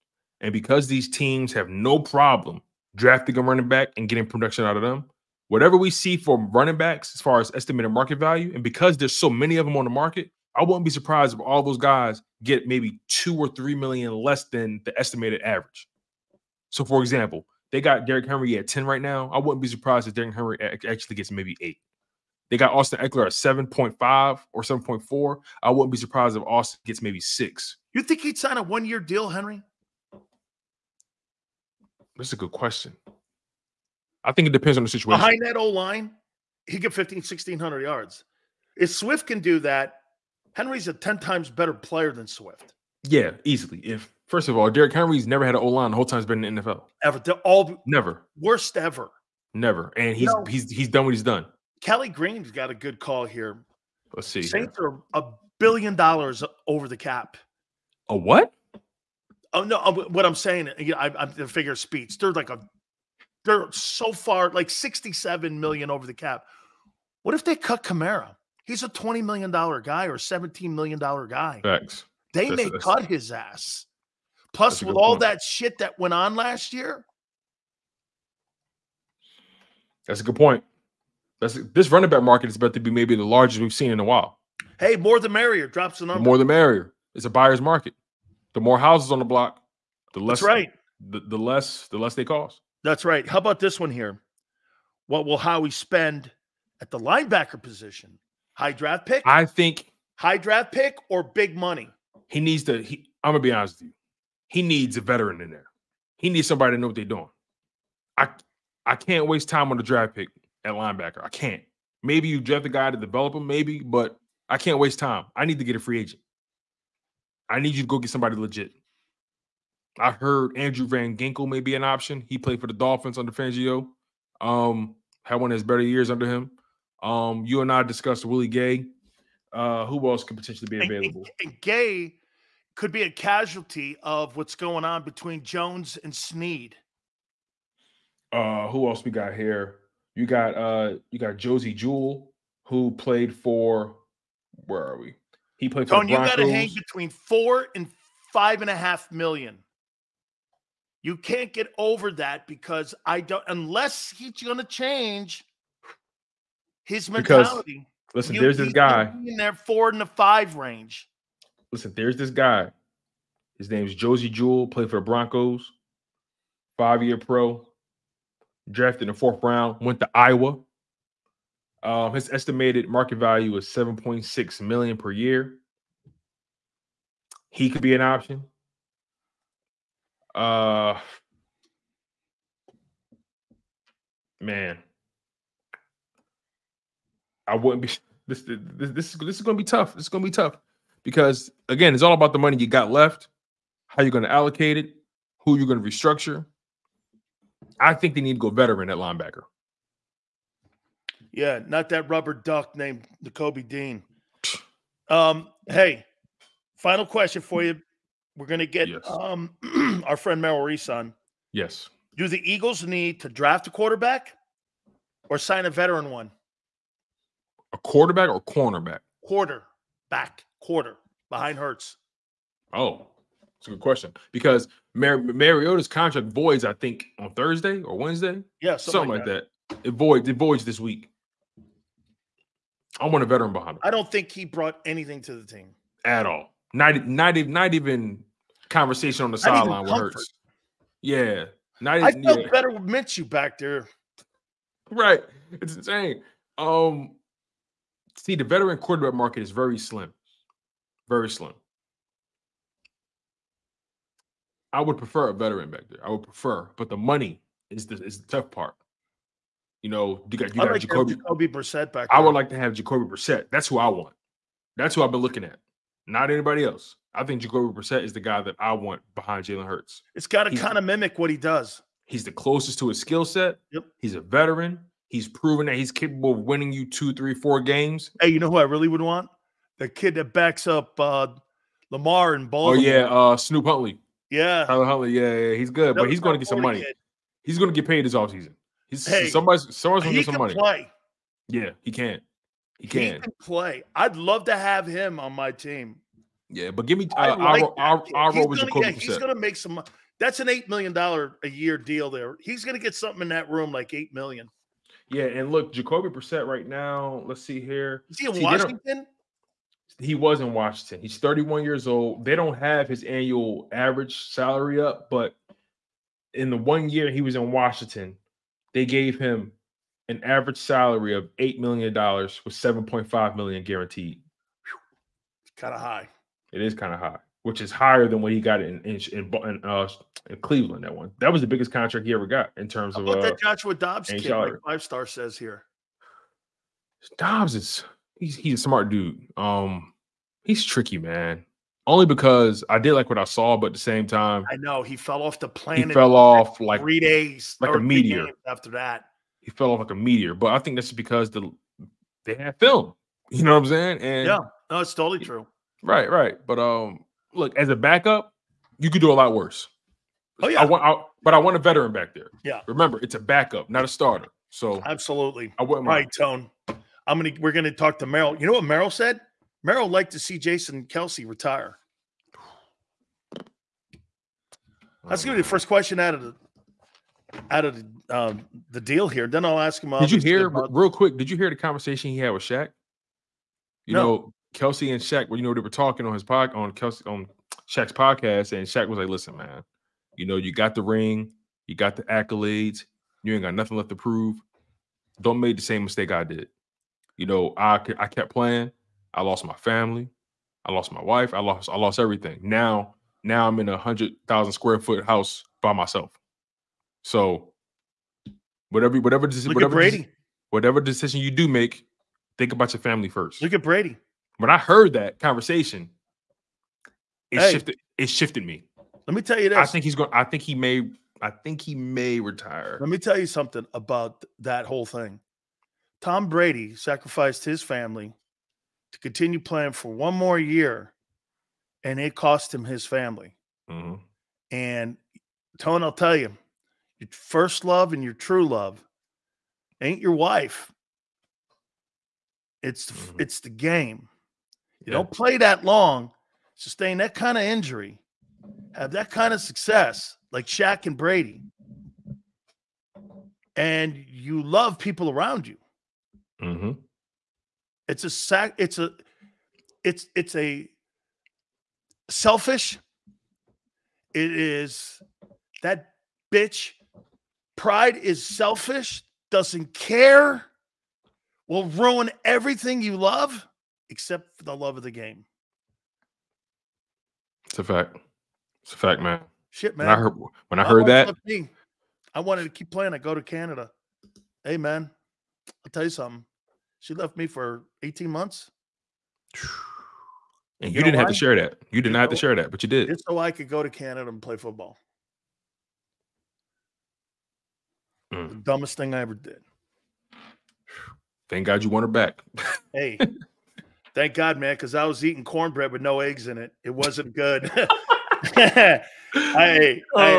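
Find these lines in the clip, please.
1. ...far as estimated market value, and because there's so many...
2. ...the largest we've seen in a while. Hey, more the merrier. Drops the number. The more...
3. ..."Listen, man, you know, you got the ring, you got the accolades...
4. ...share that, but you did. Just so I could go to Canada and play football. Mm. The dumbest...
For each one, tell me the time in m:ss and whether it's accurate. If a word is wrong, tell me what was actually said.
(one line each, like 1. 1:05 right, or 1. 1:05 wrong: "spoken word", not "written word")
1. 0:07 right
2. 1:23 right
3. 6:29 right
4. 8:12 right.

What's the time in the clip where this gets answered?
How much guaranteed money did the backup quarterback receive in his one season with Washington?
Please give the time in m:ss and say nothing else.
5:22.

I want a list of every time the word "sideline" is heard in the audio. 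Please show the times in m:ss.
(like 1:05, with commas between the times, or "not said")
3:59.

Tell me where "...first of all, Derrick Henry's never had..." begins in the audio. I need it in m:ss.
0:44.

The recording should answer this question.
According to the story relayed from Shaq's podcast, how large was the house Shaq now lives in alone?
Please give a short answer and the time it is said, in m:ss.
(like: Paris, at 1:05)
100,000 square feet, at 6:43.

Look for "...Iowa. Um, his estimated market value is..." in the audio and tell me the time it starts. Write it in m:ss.
2:50.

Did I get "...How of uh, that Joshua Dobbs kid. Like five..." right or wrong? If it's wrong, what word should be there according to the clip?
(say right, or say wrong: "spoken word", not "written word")
right.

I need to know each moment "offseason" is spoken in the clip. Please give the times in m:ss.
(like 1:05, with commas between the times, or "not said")
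4:48.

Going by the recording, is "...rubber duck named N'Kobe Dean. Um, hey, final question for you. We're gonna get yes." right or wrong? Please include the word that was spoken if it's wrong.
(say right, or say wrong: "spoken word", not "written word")
right.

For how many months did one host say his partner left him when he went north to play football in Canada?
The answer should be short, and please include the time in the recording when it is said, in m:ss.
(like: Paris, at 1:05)
18, at 8:07.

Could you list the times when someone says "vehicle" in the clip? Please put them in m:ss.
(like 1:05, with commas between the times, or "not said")
not said.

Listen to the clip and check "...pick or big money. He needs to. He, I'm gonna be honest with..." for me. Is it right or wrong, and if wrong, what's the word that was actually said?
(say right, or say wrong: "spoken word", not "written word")
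right.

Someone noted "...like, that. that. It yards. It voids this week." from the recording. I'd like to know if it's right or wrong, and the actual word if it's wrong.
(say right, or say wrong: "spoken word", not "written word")
wrong: "voids", not "yards".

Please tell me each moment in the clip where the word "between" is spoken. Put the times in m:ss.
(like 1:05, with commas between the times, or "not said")
2:15, 2:26.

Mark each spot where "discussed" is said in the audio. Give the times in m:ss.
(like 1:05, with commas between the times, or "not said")
2:07.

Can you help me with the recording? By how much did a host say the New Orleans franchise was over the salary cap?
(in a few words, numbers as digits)
67 million.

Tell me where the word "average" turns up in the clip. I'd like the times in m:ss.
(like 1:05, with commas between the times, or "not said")
0:15, 5:13, 5:20.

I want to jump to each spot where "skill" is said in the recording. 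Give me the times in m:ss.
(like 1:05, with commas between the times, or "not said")
4:33.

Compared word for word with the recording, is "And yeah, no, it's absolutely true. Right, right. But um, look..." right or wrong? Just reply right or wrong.
wrong.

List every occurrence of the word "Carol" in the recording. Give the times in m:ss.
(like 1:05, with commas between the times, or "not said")
not said.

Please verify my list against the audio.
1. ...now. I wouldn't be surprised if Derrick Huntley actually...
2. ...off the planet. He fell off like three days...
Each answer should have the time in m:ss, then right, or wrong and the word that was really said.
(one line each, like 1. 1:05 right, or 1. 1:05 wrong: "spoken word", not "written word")
1. 0:19 wrong: "Henry", not "Huntley"
2. 5:45 right.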